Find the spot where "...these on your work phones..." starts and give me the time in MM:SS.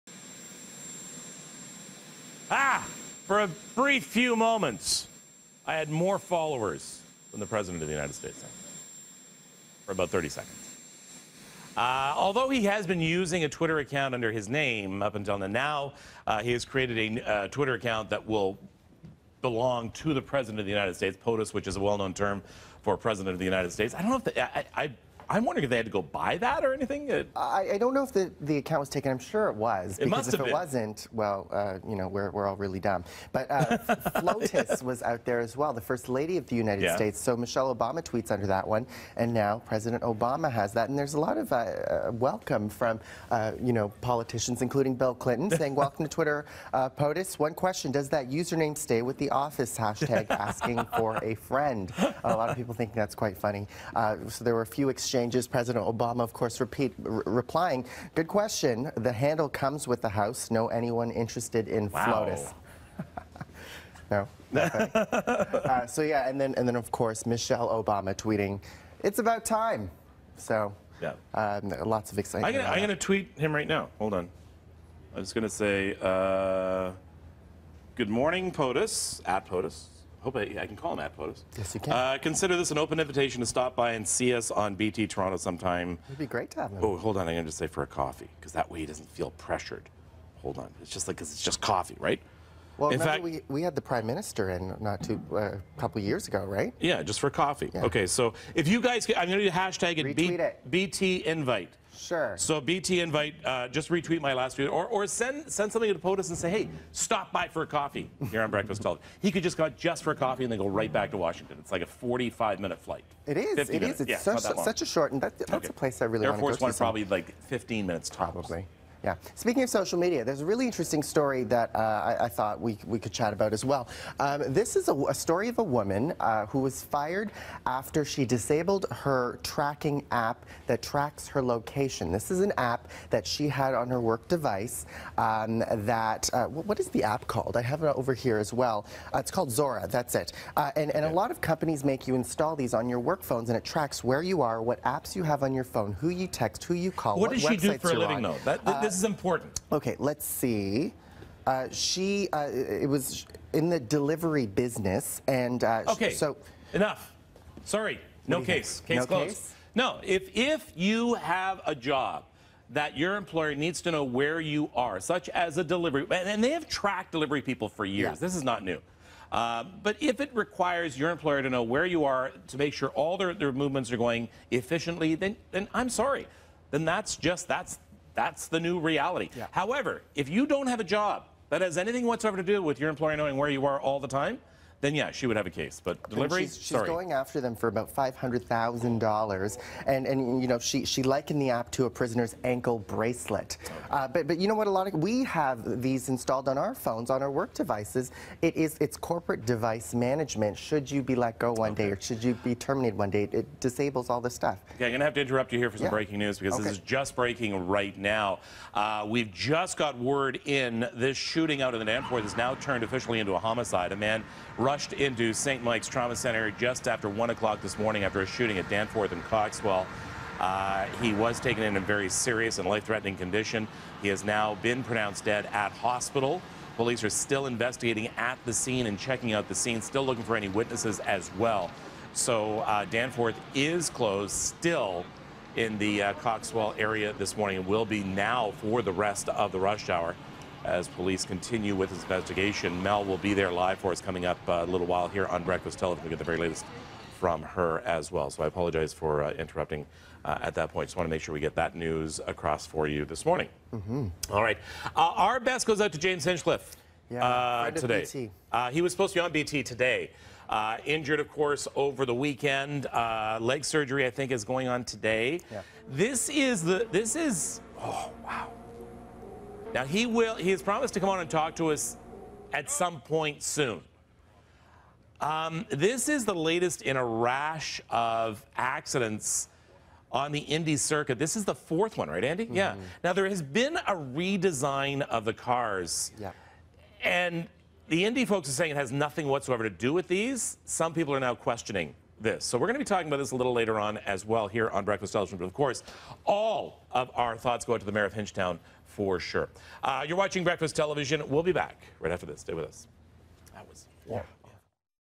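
02:22.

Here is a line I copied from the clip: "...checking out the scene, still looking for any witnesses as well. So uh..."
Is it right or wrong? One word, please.
right.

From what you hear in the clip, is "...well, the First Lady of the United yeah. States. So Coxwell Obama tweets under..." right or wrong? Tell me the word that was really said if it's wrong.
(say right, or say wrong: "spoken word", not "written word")
wrong: "Michelle", not "Coxwell".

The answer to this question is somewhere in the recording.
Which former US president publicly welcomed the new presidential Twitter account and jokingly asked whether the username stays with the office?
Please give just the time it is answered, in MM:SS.
00:44.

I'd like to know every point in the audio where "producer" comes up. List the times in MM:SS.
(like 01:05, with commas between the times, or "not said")
not said.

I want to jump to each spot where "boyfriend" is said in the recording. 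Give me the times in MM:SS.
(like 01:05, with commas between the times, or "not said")
not said.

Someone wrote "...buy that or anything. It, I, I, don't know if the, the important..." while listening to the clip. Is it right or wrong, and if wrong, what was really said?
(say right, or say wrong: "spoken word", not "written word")
wrong: "account", not "important".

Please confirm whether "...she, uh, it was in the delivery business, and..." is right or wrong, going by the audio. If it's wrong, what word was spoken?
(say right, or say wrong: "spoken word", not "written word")
right.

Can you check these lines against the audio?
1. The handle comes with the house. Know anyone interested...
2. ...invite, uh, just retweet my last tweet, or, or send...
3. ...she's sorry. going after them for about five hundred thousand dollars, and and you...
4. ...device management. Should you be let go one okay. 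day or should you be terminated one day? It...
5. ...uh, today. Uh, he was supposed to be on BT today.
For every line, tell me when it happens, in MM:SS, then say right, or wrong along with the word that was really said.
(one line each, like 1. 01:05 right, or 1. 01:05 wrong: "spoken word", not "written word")
1. 00:58 right
2. 01:43 right
3. 03:06 right
4. 03:19 right
5. 04:17 right.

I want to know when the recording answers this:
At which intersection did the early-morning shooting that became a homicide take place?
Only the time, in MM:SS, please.
03:38.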